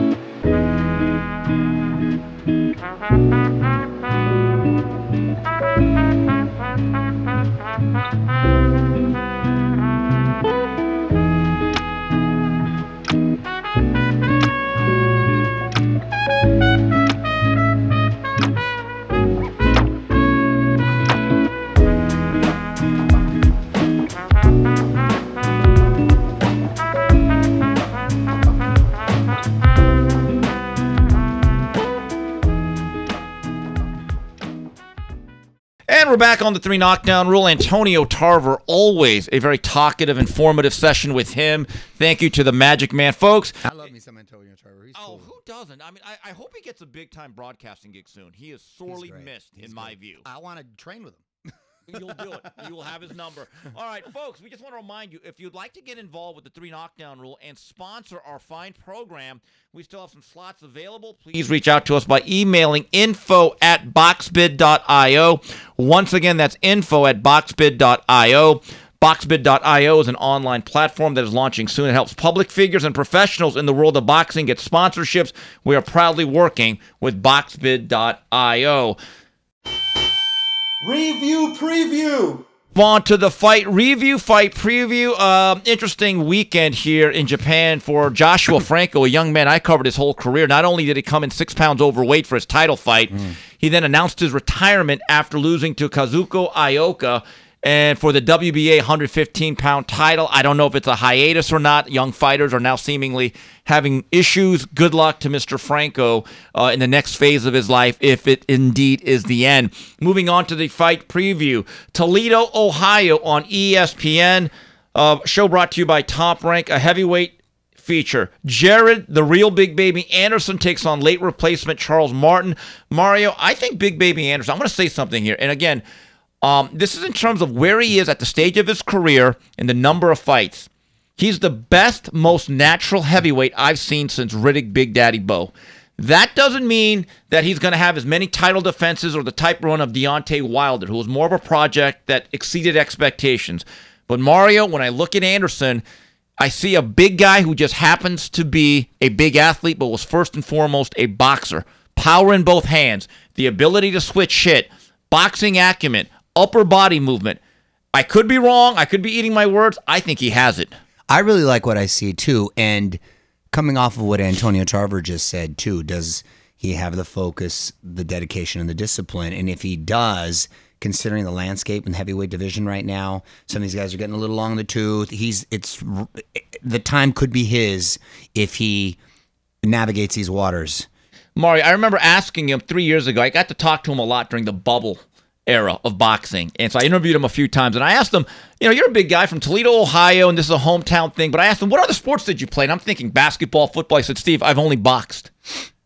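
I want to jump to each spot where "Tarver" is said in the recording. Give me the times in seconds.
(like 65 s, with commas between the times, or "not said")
38 s, 44 s, 164 s.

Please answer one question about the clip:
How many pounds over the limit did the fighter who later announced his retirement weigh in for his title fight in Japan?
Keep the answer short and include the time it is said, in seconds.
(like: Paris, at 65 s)
6, at 91 s.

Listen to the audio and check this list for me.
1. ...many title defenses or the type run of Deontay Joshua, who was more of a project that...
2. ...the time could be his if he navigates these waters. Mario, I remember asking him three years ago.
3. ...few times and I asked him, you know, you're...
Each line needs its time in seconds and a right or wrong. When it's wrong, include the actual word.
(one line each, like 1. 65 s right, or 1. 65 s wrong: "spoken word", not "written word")
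1. 138 s wrong: "Wilder", not "Joshua"
2. 176 s right
3. 187 s right.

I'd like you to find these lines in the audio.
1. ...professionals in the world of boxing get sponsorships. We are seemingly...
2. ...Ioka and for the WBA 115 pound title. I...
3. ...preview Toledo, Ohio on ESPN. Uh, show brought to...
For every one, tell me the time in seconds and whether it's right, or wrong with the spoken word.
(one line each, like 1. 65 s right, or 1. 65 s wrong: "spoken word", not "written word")
1. 72 s wrong: "proudly", not "seemingly"
2. 96 s right
3. 111 s right.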